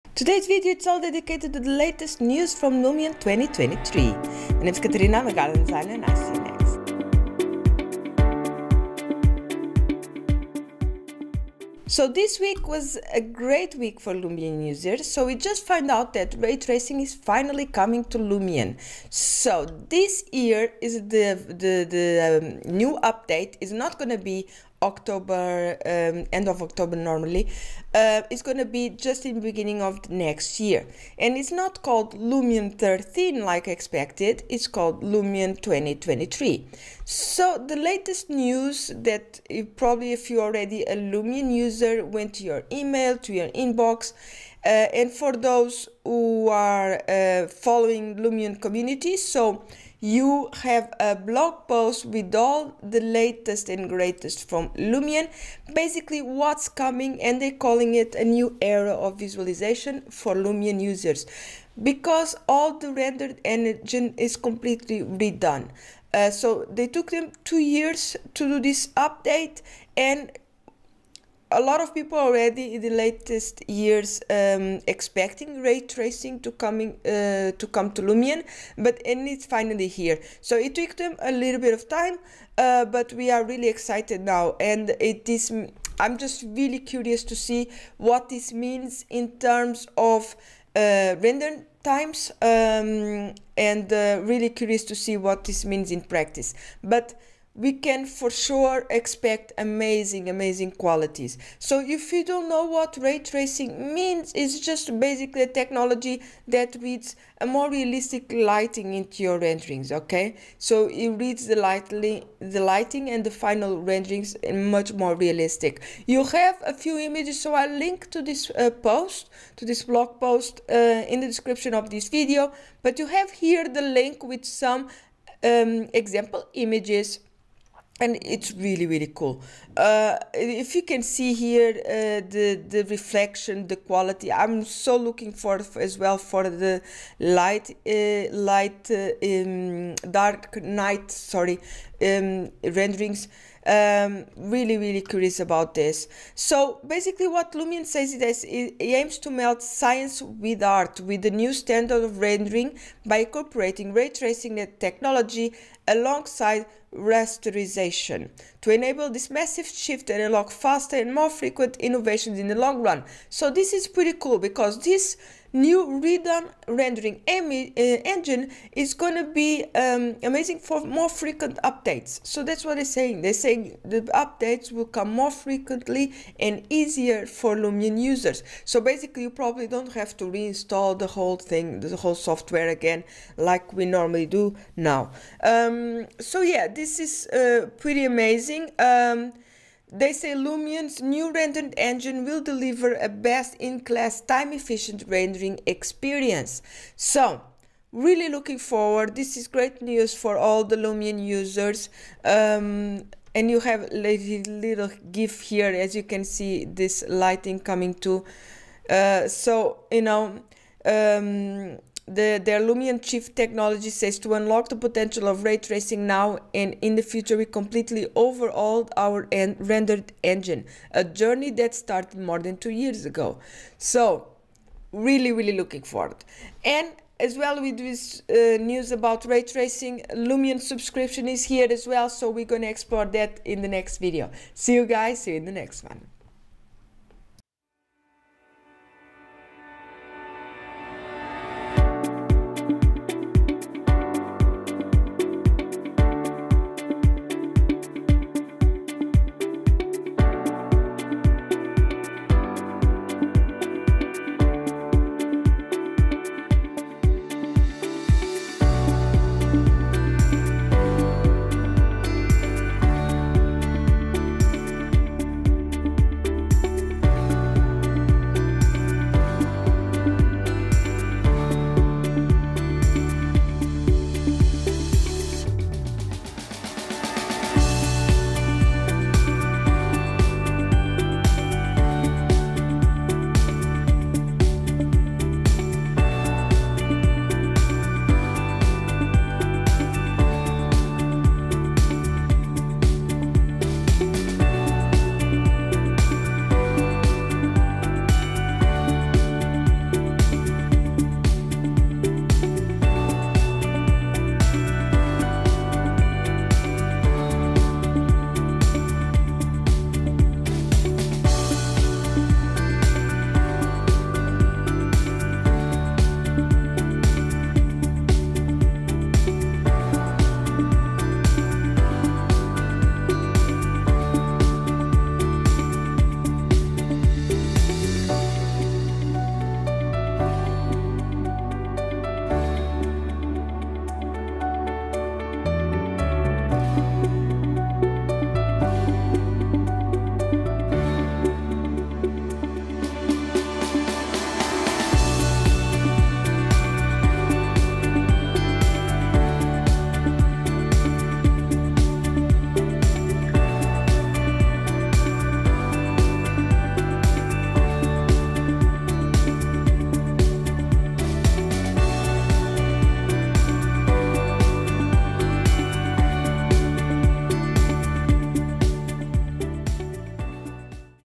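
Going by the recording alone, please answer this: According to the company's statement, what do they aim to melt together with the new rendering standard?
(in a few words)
science with art.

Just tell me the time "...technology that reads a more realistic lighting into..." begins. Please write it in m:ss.
1:45.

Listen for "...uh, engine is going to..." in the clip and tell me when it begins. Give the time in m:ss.
2:47.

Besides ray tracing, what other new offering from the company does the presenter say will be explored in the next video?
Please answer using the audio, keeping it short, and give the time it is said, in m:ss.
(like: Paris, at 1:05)
Lumion subscription, at 3:50.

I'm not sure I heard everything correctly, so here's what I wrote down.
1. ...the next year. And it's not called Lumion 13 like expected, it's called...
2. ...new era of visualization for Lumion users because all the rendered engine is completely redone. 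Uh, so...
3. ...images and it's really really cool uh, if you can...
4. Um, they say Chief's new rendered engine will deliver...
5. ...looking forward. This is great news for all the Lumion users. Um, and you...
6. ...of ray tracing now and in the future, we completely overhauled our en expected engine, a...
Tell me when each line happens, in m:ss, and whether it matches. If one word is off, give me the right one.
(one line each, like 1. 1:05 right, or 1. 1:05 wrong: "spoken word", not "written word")
1. 0:30 right
2. 0:58 right
3. 2:06 right
4. 3:08 wrong: "Lumion", not "Chief"
5. 3:18 right
6. 3:35 wrong: "rendered", not "expected".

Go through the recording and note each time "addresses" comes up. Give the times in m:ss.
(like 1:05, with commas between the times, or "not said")
not said.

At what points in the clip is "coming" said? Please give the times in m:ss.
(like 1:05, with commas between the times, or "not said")
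0:17, 0:56, 1:16, 3:27.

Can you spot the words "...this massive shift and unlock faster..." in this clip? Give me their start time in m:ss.
2:39.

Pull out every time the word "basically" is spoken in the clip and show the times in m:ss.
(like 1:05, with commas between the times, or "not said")
0:55, 1:45, 2:26, 2:58.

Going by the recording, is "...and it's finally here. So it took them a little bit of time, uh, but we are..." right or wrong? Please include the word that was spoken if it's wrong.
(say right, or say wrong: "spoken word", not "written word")
right.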